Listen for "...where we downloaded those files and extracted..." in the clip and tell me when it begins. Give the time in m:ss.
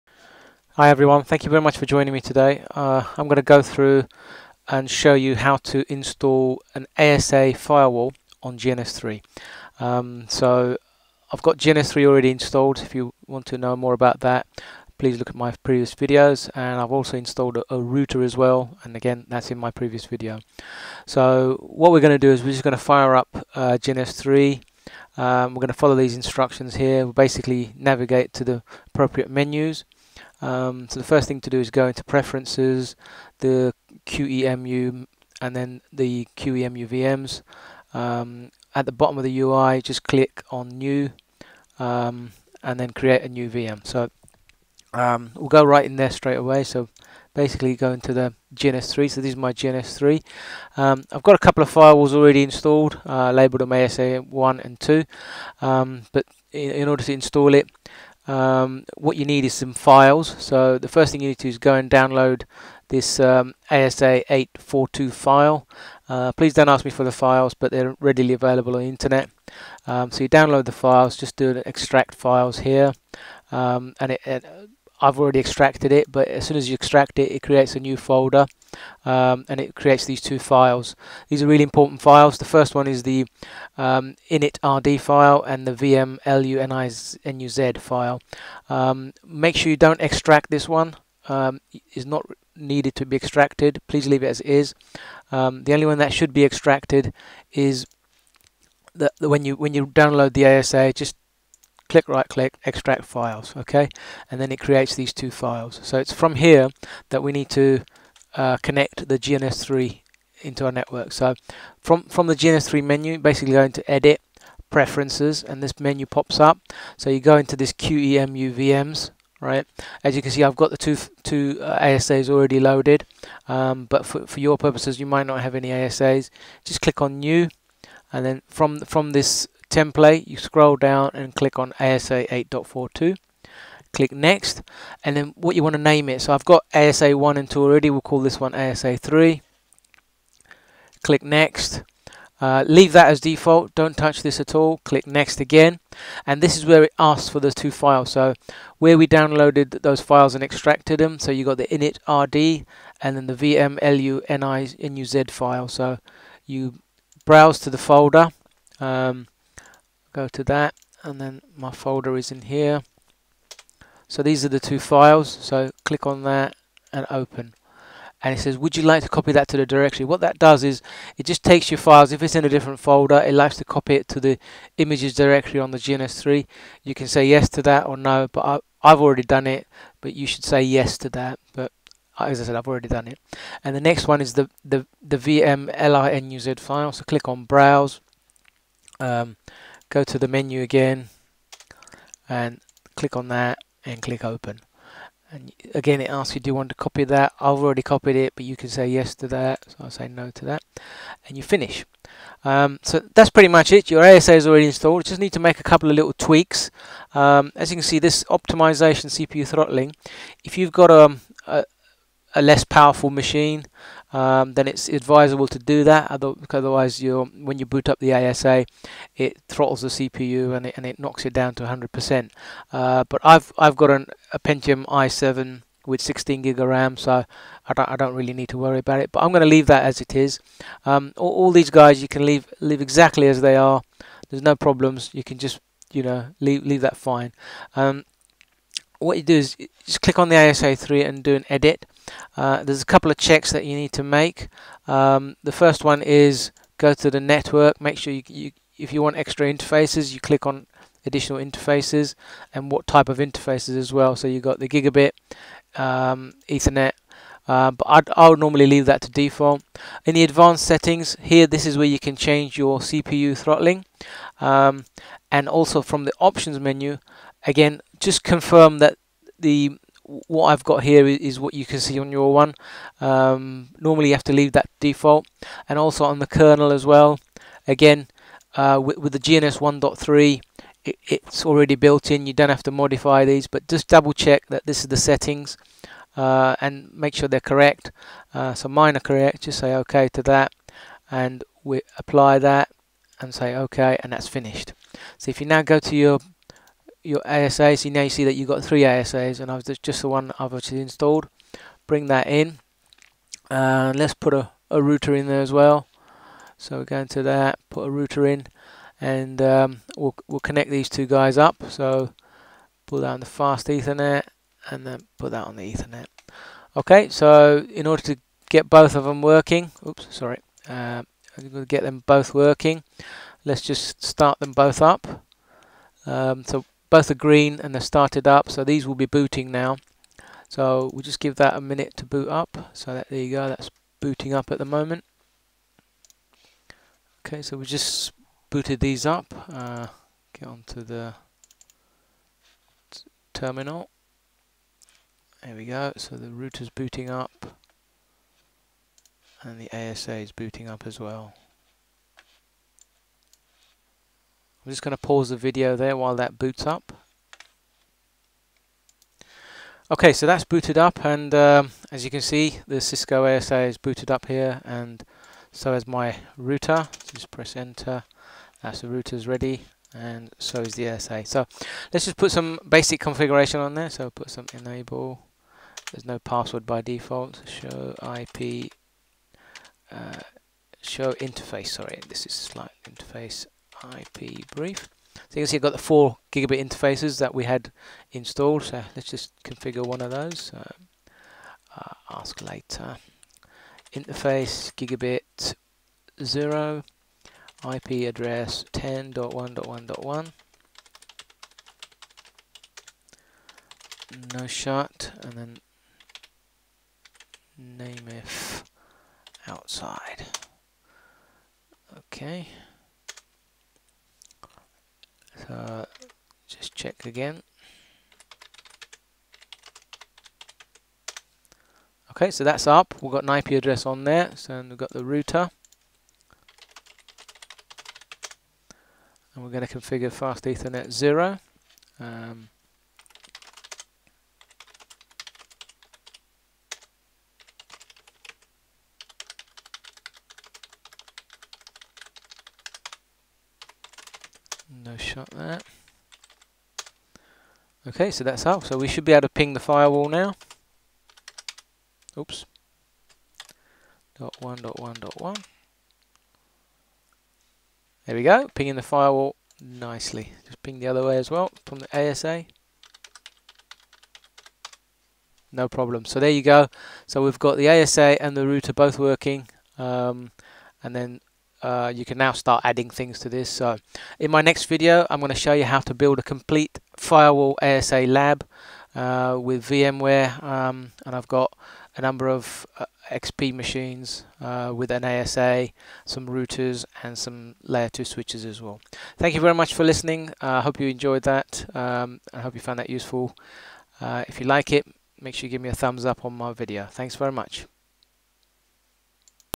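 2:28.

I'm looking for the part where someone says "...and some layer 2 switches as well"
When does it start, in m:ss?
8:07.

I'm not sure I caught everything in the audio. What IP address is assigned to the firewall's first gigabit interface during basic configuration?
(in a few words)
10.1.1.1.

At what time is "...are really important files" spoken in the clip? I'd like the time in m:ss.
1:21.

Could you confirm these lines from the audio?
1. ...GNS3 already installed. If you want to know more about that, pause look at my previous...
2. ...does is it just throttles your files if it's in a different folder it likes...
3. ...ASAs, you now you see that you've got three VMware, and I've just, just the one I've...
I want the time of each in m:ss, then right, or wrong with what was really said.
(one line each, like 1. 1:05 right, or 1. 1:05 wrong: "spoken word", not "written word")
1. 0:11 wrong: "please", not "pause"
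2. 2:50 wrong: "takes", not "throttles"
3. 4:57 wrong: "ASAs", not "VMware".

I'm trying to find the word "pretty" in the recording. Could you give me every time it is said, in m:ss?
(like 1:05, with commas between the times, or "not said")
3:23.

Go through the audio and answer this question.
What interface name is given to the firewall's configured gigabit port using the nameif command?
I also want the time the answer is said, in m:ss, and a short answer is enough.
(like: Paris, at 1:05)
outside, at 6:49.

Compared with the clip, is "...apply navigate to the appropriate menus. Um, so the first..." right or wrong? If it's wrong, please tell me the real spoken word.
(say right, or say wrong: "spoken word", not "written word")
wrong: "basically", not "apply".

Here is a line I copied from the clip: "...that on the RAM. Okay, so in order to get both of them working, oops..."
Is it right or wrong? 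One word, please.
wrong.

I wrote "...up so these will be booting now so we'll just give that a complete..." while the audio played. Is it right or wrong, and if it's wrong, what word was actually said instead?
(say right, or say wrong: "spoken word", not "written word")
wrong: "minute", not "complete".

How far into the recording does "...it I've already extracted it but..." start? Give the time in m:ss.
1:14.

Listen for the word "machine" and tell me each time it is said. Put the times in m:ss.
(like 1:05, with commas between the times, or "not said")
3:33, 8:03.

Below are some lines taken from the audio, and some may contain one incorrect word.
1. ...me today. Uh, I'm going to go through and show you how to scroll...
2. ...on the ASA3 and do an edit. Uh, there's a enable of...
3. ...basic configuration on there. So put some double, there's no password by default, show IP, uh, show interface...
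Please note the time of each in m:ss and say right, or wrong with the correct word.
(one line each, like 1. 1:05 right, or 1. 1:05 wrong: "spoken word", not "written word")
1. 0:02 wrong: "install", not "scroll"
2. 4:00 wrong: "couple", not "enable"
3. 6:12 wrong: "enable", not "double".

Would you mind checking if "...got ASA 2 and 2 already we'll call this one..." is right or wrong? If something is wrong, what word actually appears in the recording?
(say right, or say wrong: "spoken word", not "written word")
wrong: "1", not "2".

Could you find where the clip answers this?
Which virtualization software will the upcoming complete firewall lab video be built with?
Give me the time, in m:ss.
7:59.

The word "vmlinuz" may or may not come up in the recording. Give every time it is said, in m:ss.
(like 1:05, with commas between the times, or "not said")
1:25, 2:33, 3:05.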